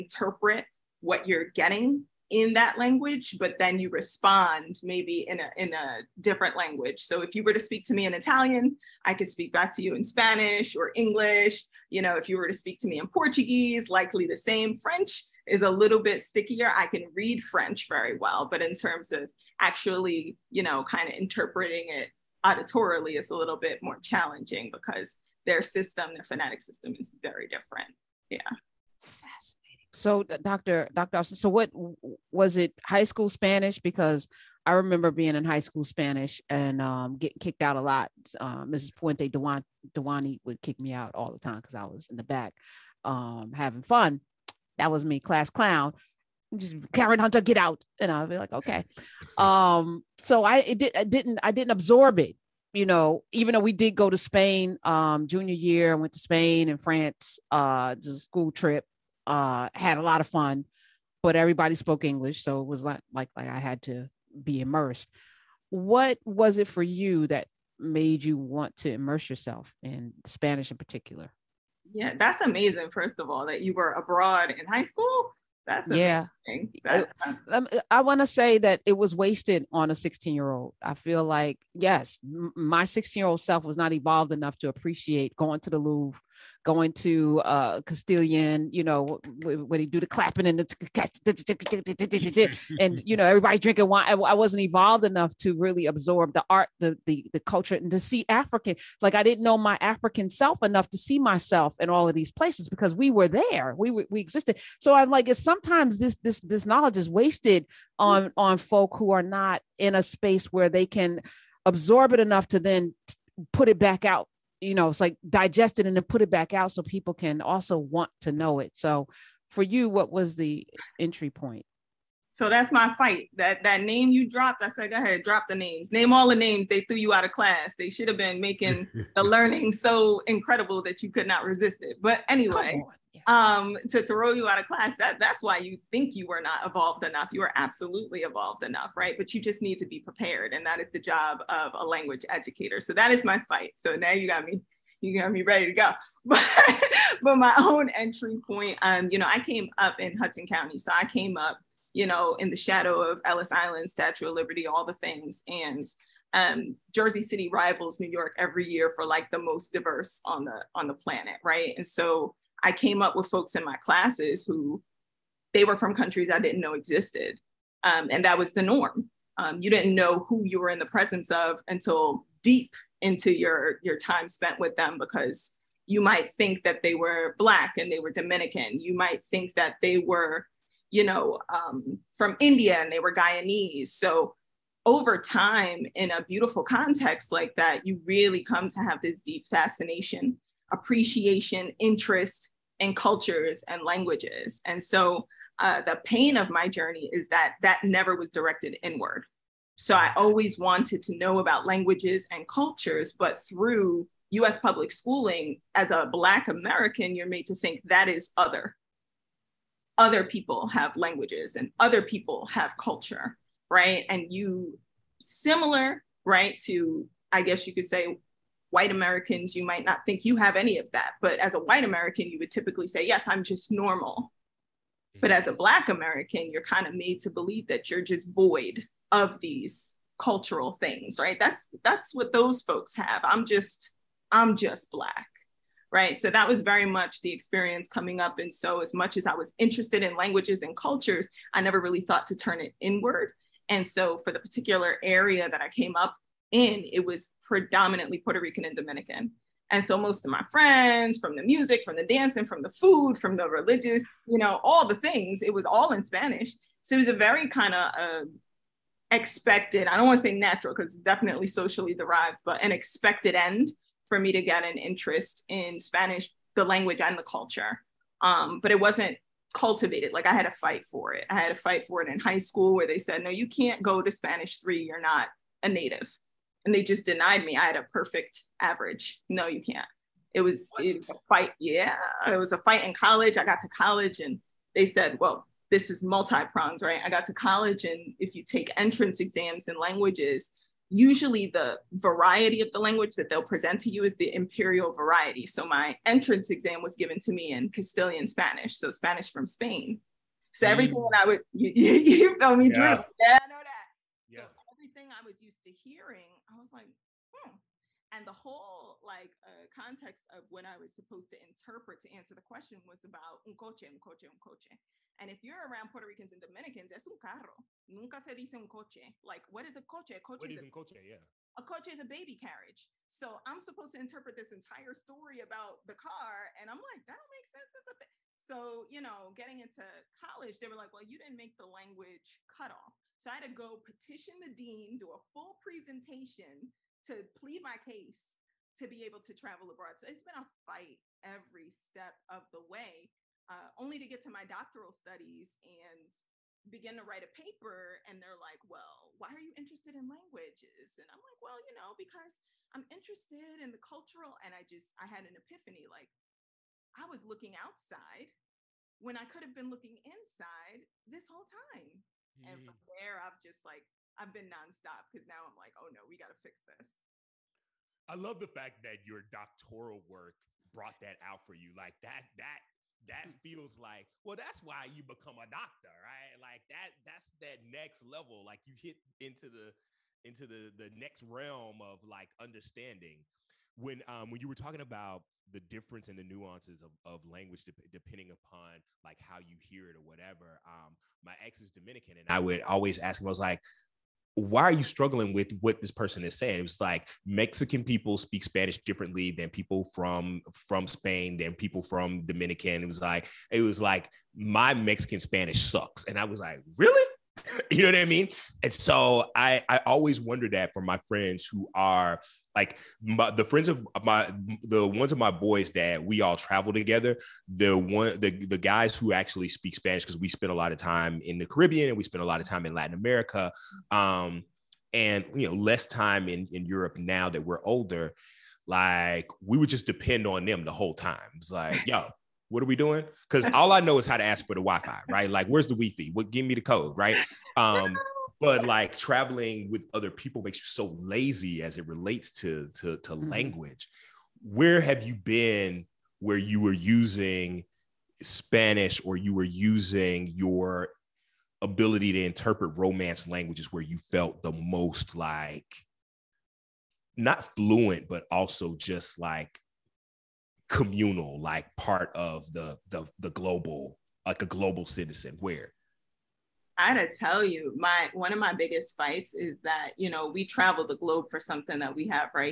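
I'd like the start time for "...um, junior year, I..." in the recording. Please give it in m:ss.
0:54.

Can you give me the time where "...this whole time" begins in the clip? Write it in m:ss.
6:01.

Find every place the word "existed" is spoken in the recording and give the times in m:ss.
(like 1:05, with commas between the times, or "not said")
1:44, 2:46.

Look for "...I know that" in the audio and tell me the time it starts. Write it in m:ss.
5:03.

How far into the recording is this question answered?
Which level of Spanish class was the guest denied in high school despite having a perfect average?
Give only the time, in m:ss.
4:34.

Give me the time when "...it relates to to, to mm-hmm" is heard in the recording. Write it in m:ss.
7:21.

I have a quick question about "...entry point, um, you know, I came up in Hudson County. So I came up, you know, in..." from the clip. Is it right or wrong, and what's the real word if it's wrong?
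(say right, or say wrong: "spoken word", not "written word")
right.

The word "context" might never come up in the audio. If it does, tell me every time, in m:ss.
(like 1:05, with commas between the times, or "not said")
3:06, 5:09.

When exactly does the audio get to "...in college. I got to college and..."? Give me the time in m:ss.
4:42.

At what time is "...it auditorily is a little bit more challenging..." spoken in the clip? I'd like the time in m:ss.
0:21.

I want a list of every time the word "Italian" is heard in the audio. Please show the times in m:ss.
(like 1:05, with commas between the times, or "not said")
0:08.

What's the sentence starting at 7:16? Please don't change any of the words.
What give me the code, right?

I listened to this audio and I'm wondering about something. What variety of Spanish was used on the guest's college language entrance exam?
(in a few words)
Castilian Spanish.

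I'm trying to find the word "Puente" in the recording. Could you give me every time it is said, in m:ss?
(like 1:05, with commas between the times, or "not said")
0:38.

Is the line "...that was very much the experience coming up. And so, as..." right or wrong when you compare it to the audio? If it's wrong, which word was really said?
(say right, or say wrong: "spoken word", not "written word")
right.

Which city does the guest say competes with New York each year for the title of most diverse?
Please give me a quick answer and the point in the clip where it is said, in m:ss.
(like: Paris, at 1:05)
Jersey City, at 2:36.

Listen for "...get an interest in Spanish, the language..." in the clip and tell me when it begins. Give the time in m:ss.
4:24.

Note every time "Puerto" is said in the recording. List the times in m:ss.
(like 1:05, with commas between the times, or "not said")
4:08, 5:15.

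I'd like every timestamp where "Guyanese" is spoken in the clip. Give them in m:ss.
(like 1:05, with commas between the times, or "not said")
3:03.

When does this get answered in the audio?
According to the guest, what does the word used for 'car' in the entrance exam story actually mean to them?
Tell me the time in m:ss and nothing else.
5:22.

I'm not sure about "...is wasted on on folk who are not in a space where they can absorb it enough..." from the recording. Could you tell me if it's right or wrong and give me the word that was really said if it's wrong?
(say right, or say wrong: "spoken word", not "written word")
right.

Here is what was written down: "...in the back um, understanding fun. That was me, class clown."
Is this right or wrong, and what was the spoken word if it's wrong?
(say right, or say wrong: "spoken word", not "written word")
wrong: "having", not "understanding".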